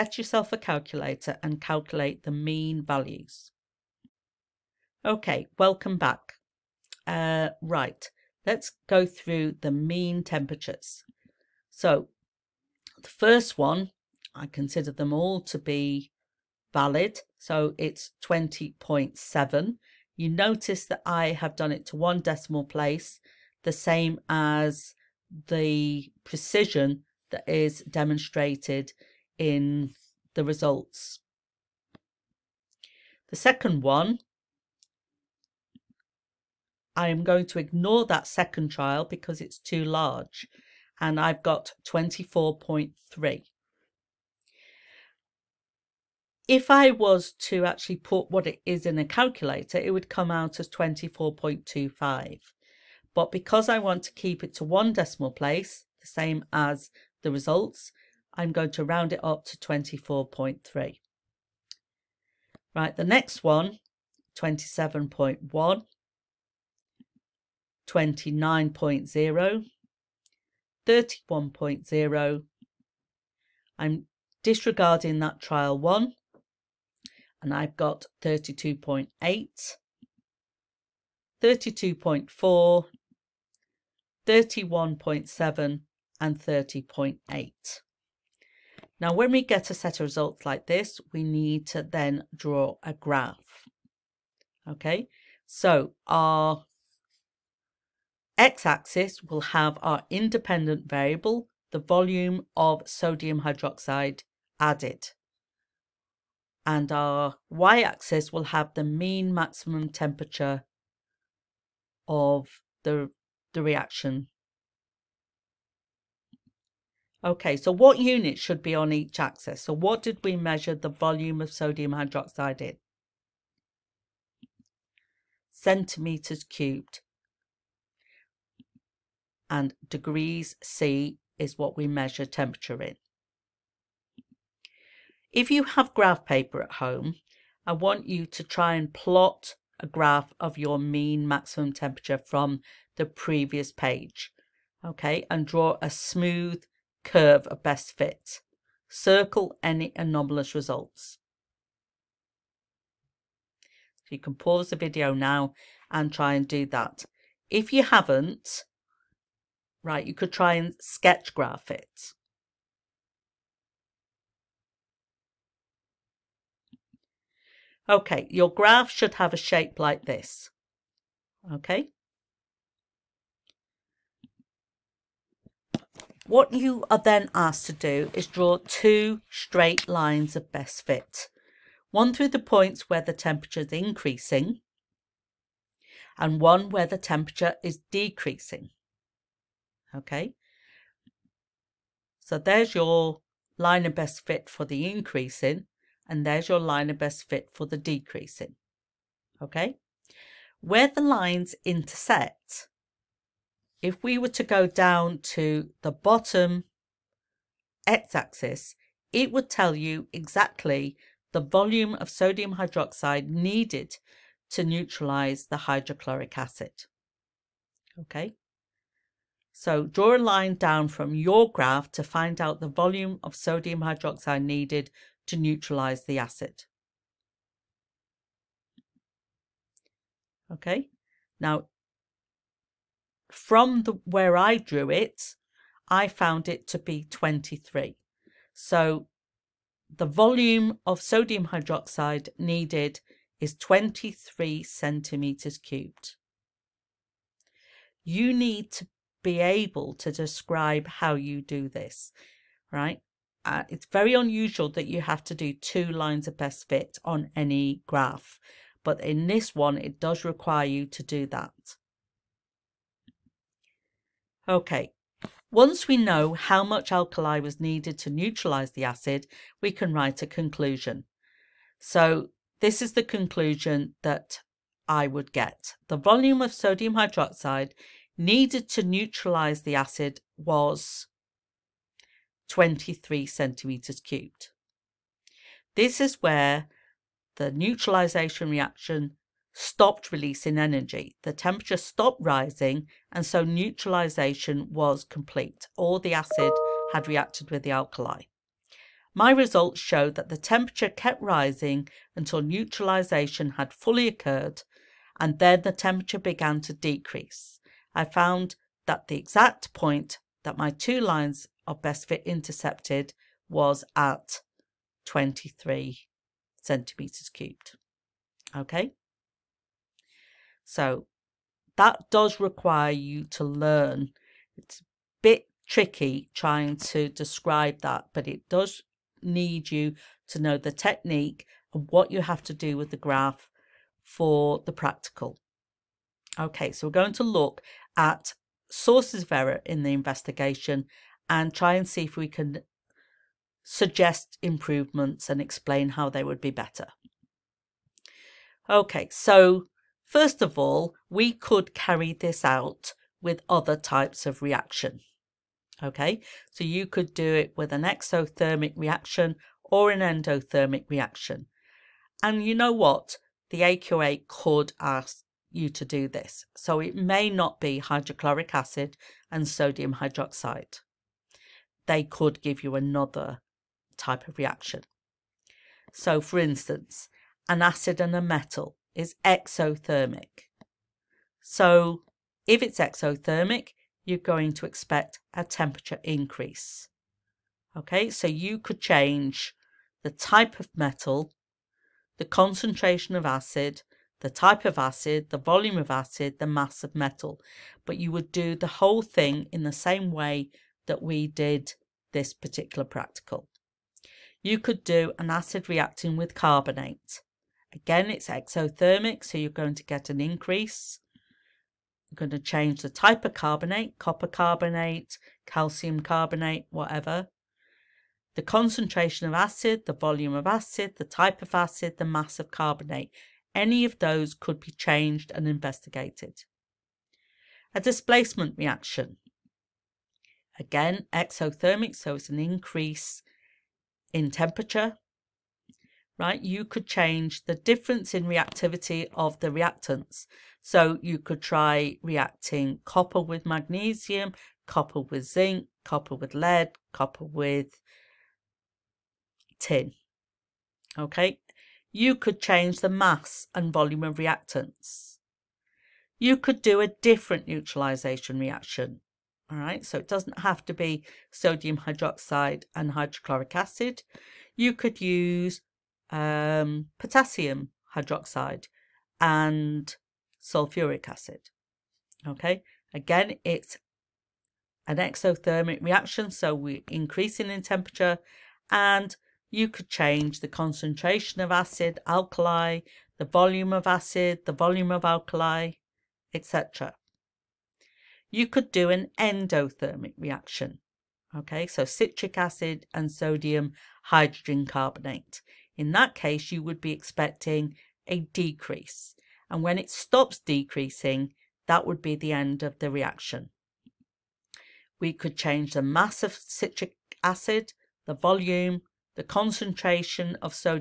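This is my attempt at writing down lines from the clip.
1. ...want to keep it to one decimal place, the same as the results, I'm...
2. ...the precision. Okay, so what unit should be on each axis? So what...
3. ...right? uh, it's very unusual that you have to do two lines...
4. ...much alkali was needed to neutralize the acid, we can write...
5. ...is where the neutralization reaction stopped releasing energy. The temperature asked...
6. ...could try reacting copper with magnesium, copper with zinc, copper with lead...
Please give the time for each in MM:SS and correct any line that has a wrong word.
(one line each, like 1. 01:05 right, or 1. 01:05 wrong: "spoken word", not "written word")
1. 00:53 right
2. 01:53 wrong: "reaction", not "precision"
3. 04:12 right
4. 04:26 right
5. 04:45 wrong: "stopped", not "asked"
6. 07:21 right.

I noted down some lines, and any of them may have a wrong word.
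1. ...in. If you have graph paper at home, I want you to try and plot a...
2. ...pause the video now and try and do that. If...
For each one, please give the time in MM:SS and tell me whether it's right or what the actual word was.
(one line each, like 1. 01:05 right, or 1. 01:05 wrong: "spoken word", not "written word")
1. 02:12 right
2. 02:34 right.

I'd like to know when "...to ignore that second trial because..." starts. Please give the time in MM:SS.
00:37.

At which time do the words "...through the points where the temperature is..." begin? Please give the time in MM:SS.
03:02.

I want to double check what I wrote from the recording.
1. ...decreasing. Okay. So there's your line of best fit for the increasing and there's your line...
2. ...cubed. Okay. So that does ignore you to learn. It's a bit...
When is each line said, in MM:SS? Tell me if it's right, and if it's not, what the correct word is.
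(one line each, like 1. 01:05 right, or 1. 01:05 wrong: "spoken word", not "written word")
1. 03:07 right
2. 05:17 wrong: "require", not "ignore".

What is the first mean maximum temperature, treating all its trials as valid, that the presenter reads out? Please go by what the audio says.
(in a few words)
20.7.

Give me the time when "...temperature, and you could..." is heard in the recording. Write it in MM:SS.
07:57.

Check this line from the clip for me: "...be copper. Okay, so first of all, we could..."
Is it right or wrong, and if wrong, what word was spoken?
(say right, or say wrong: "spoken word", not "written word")
wrong: "better", not "copper".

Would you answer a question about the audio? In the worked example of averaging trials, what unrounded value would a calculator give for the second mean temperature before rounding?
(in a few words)
24.25.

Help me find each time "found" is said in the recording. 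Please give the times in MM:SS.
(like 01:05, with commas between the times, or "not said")
03:56, 05:08.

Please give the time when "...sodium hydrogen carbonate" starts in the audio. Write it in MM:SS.
08:13.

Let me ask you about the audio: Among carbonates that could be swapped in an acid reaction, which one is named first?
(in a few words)
copper carbonate.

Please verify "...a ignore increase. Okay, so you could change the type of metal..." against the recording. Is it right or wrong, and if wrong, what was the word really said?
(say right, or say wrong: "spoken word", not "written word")
wrong: "temperature", not "ignore".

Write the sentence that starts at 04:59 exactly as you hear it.
My results showed that the temperature kept rising until neutralization had fully occurred, and then the temperature began to decrease.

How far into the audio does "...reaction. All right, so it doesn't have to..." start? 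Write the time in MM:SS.
07:38.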